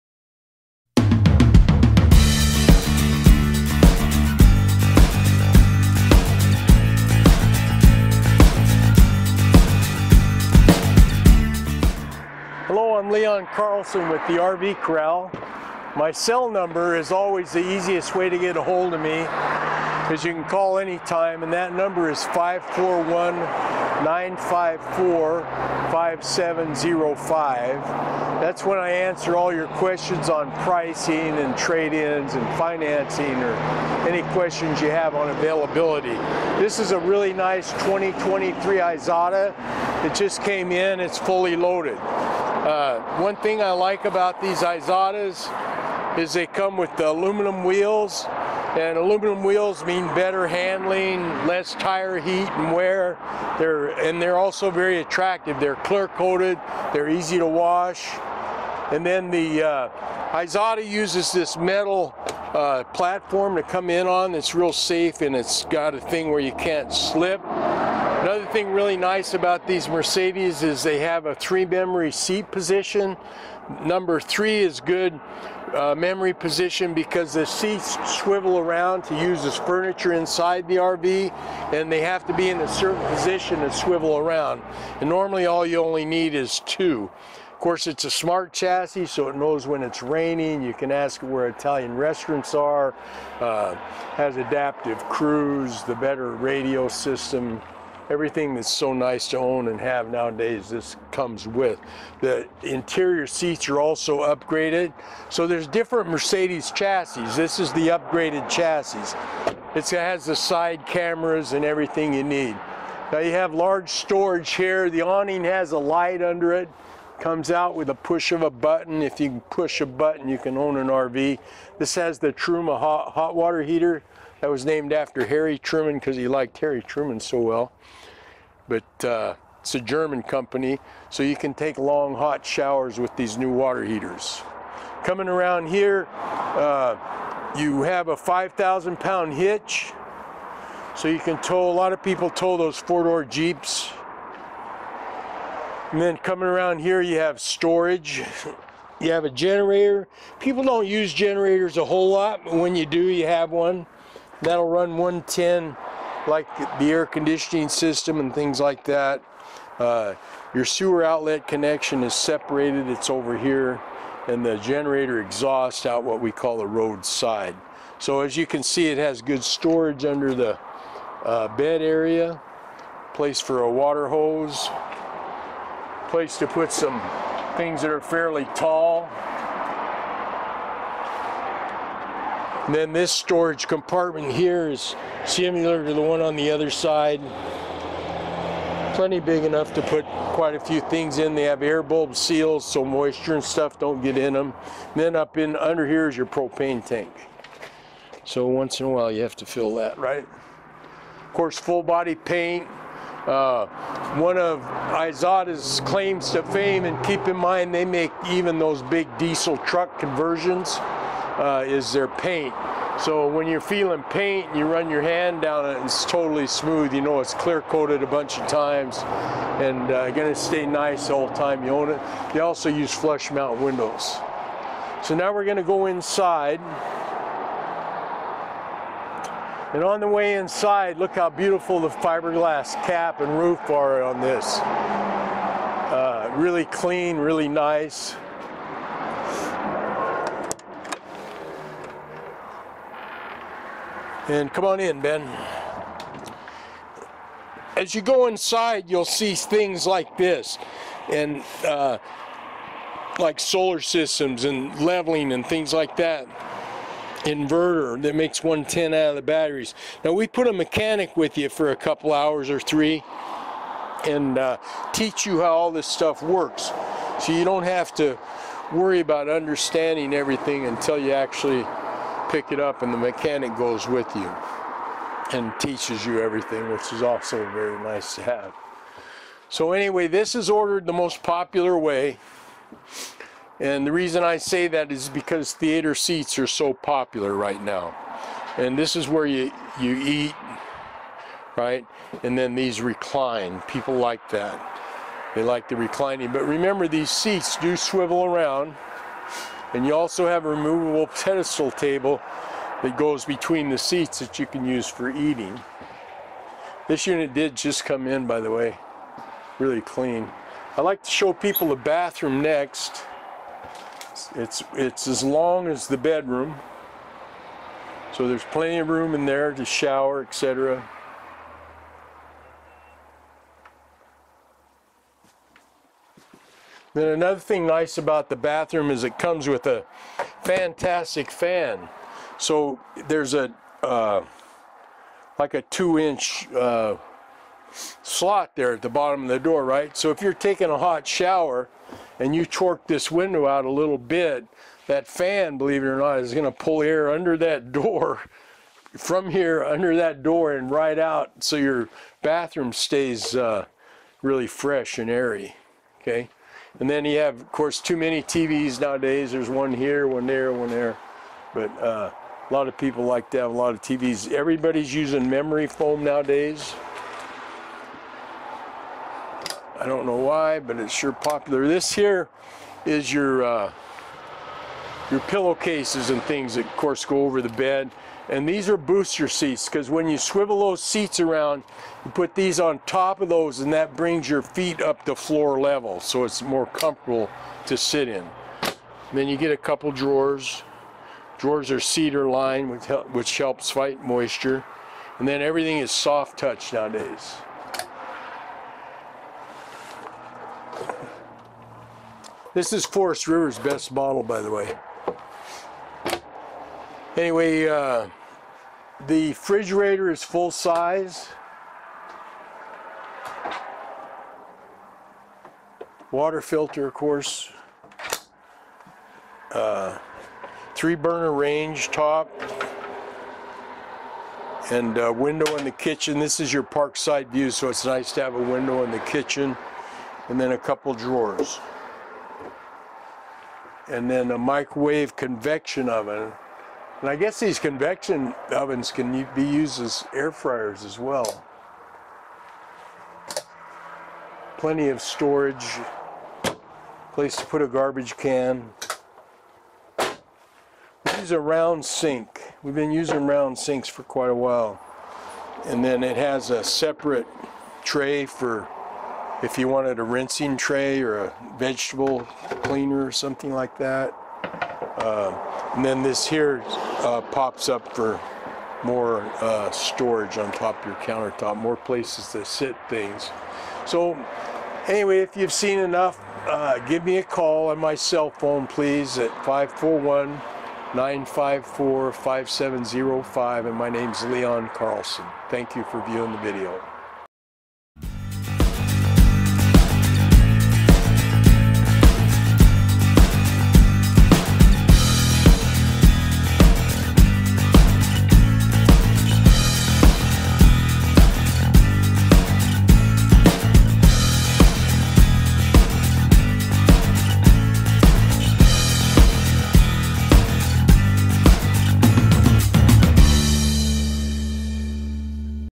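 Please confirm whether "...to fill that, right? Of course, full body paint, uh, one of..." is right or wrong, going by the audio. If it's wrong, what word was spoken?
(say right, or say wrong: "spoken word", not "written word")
right.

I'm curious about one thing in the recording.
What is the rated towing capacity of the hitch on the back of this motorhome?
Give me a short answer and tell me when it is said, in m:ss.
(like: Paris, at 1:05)
5,000 pounds, at 2:18.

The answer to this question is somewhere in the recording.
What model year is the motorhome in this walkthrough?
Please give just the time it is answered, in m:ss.
0:37.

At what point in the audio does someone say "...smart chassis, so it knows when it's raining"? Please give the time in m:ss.
1:28.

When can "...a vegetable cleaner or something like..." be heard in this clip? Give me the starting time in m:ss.
7:41.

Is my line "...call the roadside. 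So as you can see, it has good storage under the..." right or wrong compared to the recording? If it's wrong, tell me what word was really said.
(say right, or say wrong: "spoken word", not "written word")
right.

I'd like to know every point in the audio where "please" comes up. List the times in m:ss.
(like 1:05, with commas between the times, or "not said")
7:58.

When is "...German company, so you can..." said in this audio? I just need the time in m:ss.
2:09.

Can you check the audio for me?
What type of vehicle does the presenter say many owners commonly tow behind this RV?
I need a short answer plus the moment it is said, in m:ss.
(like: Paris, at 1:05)
Four door Jeeps, at 2:22.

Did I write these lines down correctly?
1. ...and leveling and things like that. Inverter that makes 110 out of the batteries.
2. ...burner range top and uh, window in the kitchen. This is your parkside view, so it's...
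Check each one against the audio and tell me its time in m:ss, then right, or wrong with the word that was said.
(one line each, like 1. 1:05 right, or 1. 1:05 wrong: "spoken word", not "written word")
1. 4:14 right
2. 7:00 right.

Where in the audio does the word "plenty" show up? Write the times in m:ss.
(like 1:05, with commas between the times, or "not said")
3:08, 5:18, 7:24.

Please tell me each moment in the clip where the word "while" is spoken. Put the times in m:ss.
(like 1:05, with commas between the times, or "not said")
3:18, 7:34.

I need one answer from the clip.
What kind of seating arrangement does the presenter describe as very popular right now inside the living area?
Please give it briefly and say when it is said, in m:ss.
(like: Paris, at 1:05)
Theater seats, at 4:45.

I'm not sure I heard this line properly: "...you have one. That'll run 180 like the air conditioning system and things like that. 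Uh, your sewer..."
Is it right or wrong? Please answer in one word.
wrong.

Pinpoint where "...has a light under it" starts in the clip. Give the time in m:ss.
1:55.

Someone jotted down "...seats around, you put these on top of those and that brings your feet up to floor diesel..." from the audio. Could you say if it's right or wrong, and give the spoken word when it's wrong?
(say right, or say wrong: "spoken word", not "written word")
wrong: "level", not "diesel".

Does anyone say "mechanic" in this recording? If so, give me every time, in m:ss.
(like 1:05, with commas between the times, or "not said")
4:20, 4:32.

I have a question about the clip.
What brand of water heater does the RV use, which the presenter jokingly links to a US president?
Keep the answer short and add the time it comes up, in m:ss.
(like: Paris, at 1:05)
Truma, at 2:02.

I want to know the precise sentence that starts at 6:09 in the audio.
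I don't know why, but it's sure popular.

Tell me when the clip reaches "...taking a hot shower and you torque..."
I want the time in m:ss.
5:40.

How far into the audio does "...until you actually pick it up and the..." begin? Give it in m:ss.
4:30.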